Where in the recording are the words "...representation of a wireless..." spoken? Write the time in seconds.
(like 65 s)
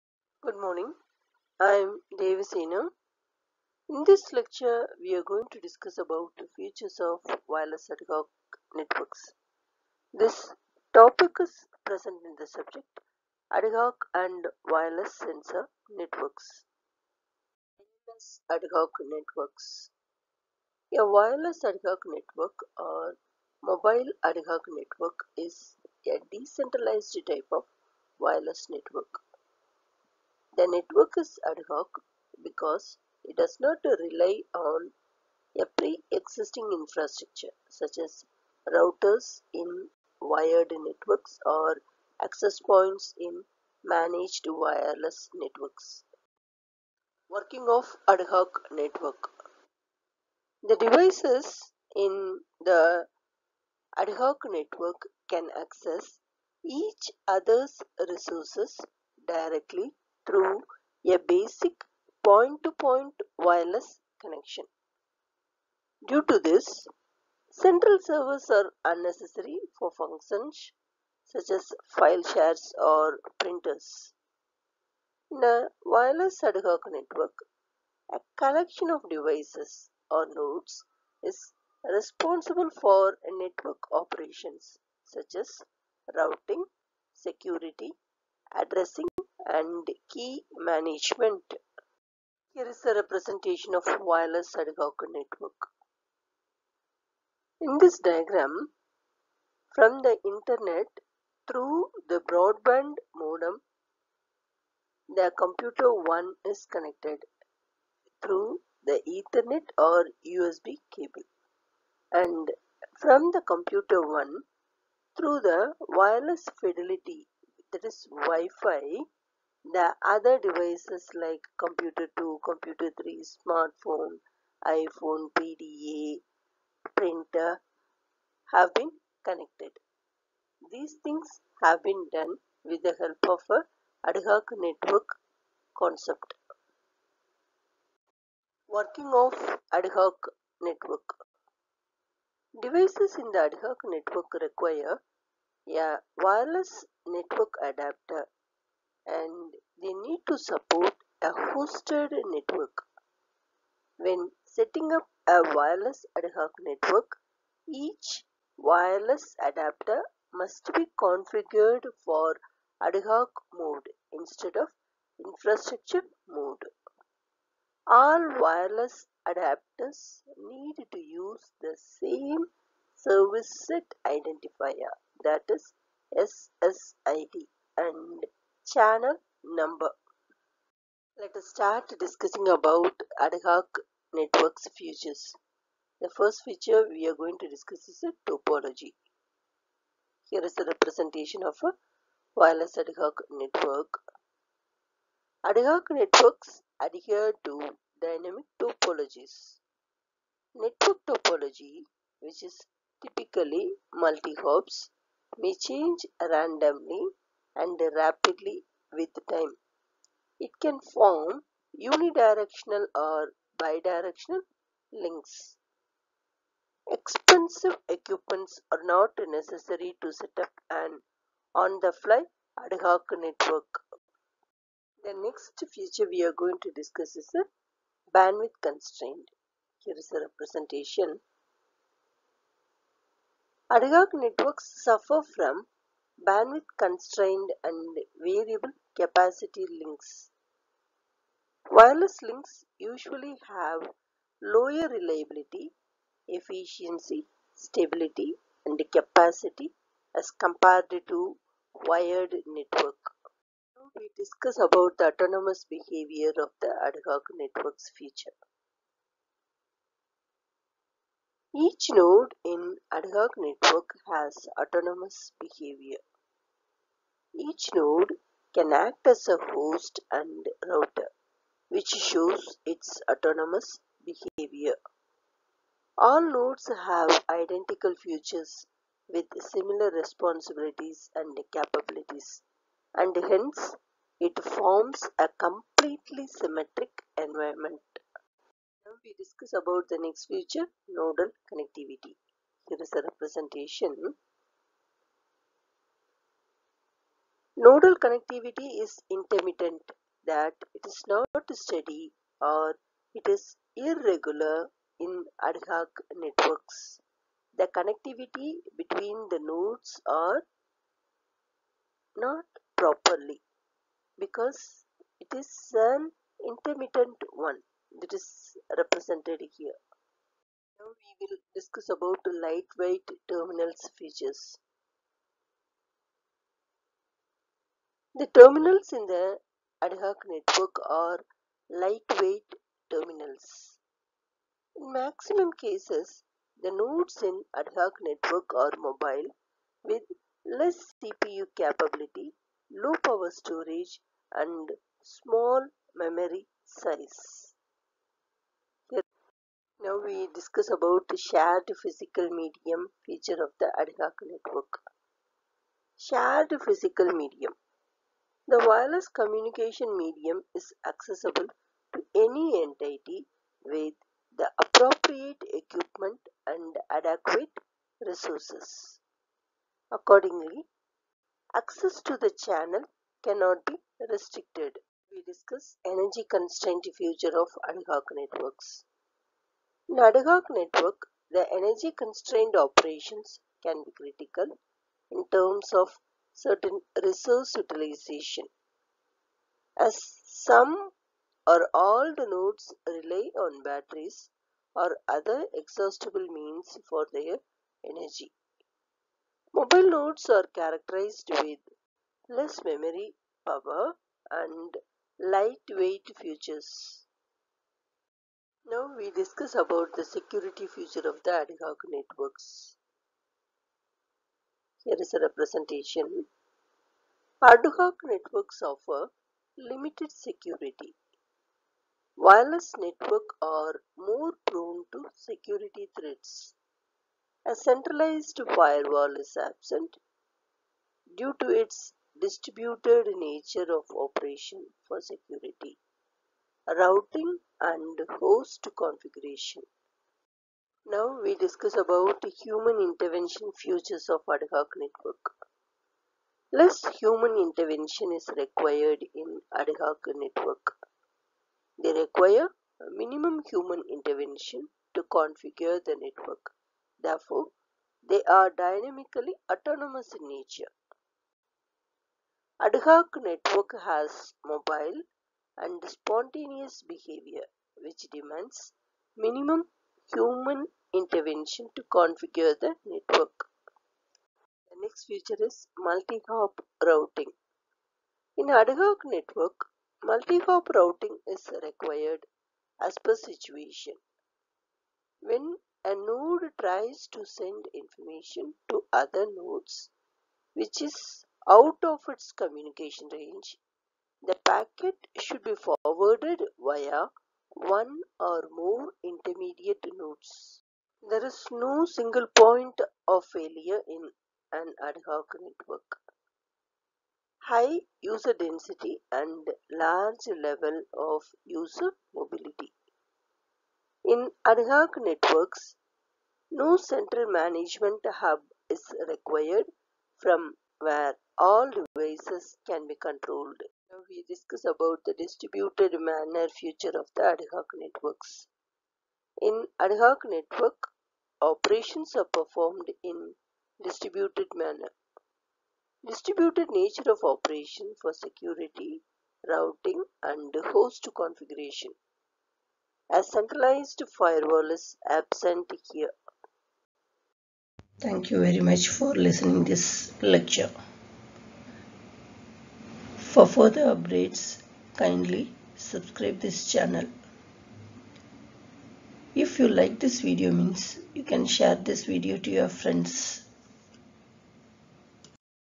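190 s.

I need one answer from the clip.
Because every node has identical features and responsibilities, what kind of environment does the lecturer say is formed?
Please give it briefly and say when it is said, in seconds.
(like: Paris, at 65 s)
completely symmetric environment, at 285 s.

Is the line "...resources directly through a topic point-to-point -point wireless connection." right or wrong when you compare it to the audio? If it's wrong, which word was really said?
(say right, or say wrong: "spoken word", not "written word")
wrong: "basic", not "topic".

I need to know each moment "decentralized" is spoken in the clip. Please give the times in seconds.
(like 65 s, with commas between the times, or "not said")
26 s.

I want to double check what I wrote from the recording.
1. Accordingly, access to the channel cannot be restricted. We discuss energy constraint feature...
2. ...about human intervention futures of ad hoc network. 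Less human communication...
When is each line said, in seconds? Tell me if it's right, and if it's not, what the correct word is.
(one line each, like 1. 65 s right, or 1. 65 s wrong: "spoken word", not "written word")
1. 369 s wrong: "future", not "feature"
2. 441 s wrong: "intervention", not "communication".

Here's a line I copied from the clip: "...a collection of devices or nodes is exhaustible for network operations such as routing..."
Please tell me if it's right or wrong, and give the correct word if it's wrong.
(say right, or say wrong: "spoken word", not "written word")
wrong: "responsible", not "exhaustible".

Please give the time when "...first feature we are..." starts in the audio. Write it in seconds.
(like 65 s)
186 s.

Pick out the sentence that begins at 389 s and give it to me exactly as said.
As some or all the nodes rely on batteries or other exhaustible means for their energy.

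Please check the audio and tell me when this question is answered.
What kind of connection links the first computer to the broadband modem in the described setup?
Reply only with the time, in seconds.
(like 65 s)
109 s.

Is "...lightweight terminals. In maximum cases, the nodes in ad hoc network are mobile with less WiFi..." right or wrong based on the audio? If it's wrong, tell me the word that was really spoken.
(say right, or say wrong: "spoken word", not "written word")
wrong: "CPU", not "WiFi".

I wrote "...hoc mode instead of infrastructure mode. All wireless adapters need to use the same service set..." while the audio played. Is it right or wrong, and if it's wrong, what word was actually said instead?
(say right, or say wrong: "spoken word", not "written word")
right.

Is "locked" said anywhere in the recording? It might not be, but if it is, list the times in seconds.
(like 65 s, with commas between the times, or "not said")
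not said.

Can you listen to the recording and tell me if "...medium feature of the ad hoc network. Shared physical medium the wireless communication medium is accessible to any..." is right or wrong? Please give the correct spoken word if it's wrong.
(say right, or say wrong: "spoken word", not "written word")
right.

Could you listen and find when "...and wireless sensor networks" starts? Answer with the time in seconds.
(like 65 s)
14 s.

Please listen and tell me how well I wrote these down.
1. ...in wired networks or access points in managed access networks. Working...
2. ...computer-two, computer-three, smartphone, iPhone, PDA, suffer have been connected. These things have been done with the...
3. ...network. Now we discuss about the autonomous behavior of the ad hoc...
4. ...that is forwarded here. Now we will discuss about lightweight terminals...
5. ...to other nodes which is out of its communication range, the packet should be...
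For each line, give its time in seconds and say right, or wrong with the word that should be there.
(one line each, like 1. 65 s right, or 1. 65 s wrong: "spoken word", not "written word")
1. 39 s wrong: "wireless", not "access"
2. 121 s wrong: "printer", not "suffer"
3. 252 s right
4. 317 s wrong: "represented", not "forwarded"
5. 488 s right.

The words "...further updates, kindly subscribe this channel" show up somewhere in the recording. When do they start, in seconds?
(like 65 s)
553 s.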